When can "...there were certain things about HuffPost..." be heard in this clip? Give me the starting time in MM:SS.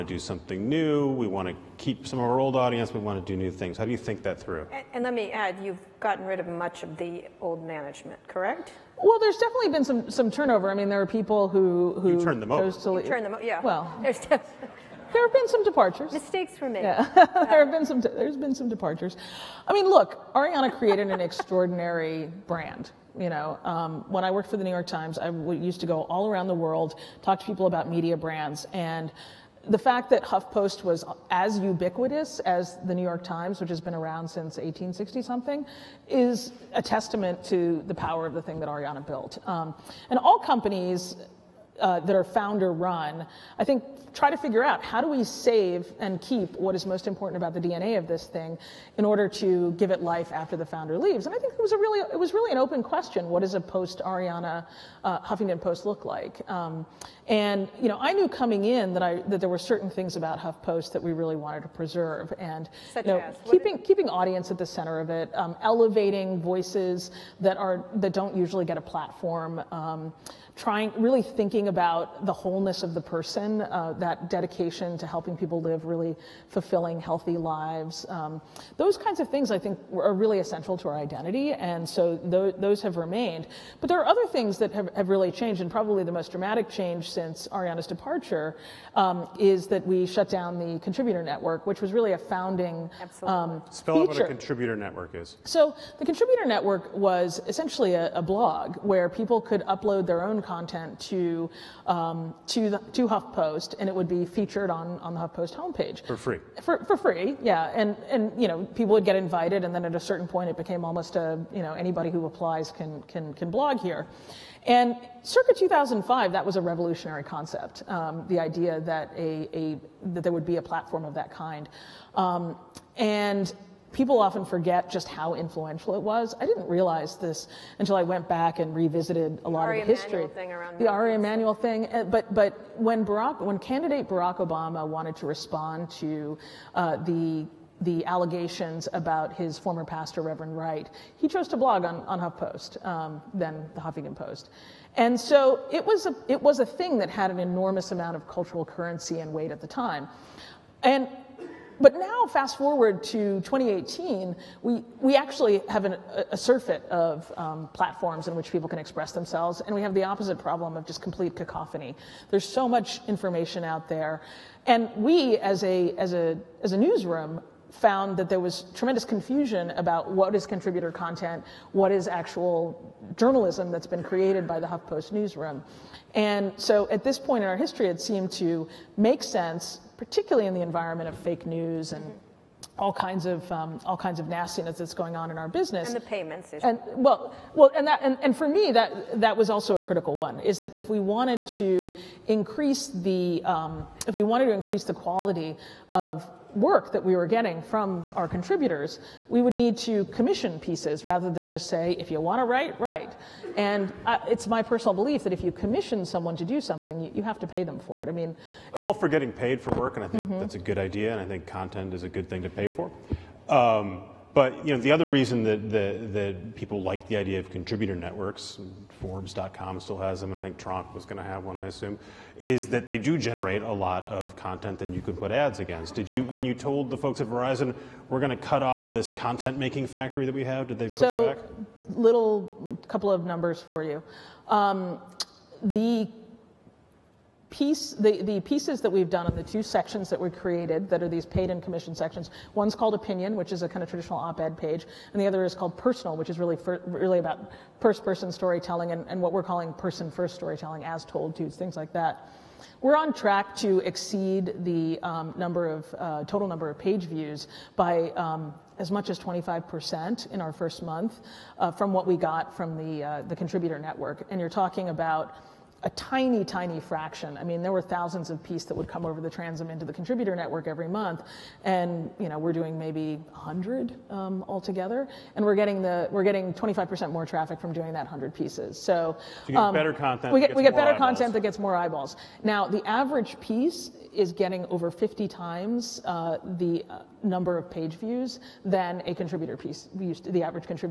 00:59.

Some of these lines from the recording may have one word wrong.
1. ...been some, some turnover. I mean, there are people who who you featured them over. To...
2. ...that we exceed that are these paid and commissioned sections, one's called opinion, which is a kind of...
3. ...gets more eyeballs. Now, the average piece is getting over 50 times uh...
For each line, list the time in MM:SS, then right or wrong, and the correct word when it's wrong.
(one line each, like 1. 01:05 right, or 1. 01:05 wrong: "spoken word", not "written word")
1. 00:09 wrong: "turned", not "featured"
2. 04:00 wrong: "created", not "exceed"
3. 04:41 right.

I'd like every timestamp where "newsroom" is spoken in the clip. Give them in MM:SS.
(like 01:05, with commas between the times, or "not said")
02:46, 02:55.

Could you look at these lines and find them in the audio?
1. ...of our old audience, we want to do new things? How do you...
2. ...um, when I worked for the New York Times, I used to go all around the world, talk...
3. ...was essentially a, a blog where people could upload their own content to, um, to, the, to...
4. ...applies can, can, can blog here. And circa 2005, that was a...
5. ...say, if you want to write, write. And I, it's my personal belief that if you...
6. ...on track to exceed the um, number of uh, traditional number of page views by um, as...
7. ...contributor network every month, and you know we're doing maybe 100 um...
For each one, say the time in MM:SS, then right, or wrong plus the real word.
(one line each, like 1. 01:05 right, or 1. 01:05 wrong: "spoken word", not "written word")
1. 00:02 right
2. 00:23 right
3. 01:36 right
4. 01:52 right
5. 03:21 right
6. 04:12 wrong: "total", not "traditional"
7. 04:29 right.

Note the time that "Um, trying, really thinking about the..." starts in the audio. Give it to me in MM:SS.
01:09.